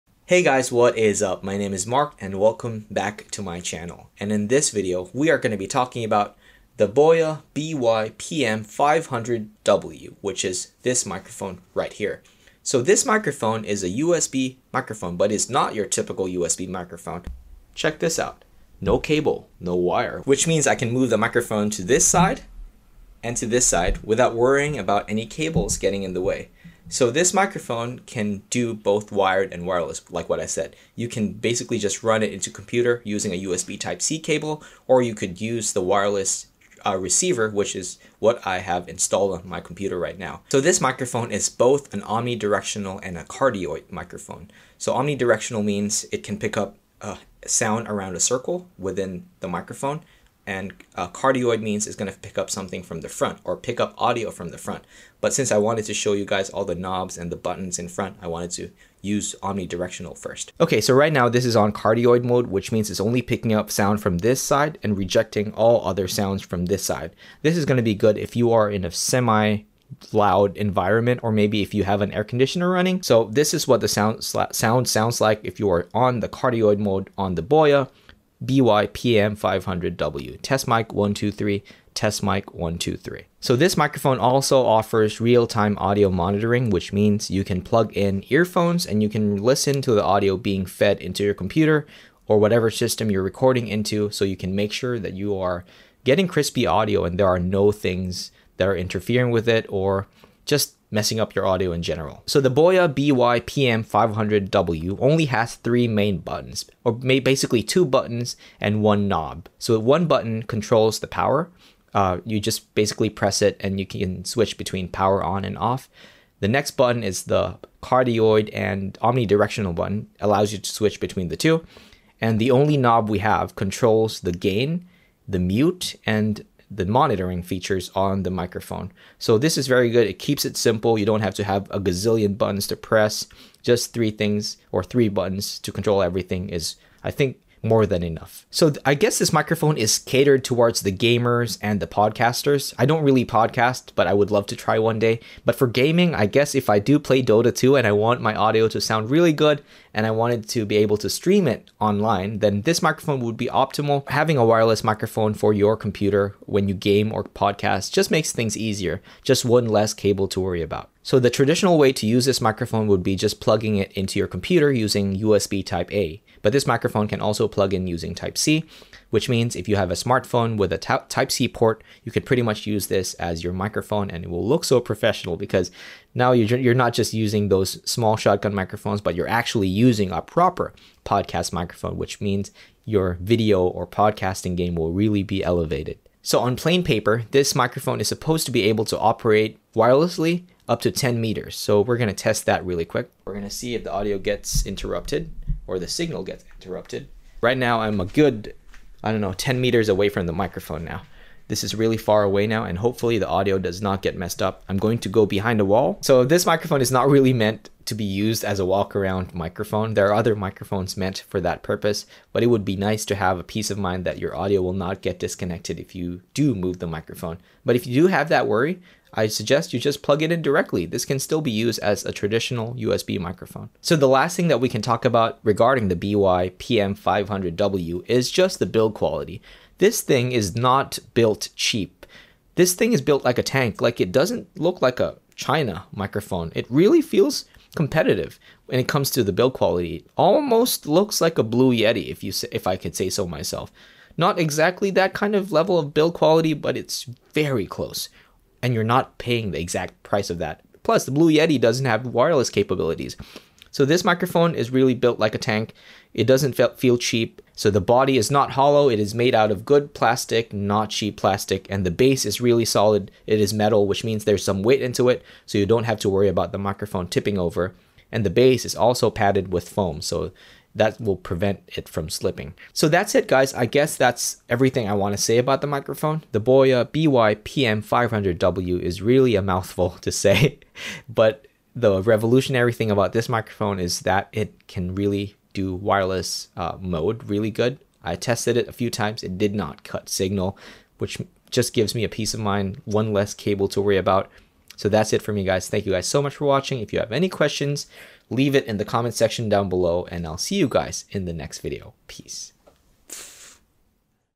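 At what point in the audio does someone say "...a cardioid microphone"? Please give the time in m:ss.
0:43.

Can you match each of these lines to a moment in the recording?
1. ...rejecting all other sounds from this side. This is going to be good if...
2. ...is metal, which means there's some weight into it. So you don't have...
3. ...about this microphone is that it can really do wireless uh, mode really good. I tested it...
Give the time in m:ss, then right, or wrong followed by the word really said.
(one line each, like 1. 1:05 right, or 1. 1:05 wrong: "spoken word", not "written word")
1. 1:04 right
2. 4:23 right
3. 4:42 right.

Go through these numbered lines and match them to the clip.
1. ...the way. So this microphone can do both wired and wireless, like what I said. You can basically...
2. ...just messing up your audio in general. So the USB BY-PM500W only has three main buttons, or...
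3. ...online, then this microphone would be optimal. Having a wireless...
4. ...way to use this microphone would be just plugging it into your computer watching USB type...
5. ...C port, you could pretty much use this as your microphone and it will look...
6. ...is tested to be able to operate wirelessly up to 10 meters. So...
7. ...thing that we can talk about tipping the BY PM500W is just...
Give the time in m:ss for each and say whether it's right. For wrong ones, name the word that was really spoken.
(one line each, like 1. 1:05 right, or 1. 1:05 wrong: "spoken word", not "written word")
1. 0:26 right
2. 1:40 wrong: "Boya", not "USB"
3. 2:31 right
4. 2:41 wrong: "using", not "watching"
5. 2:51 right
6. 3:07 wrong: "supposed", not "tested"
7. 3:44 wrong: "regarding", not "tipping".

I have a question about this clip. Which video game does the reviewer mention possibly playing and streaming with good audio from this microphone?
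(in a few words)
Dota 2.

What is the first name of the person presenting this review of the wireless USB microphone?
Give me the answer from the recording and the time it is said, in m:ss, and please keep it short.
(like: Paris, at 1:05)
Mark, at 0:01.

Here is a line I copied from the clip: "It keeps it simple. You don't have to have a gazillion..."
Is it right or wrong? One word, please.
right.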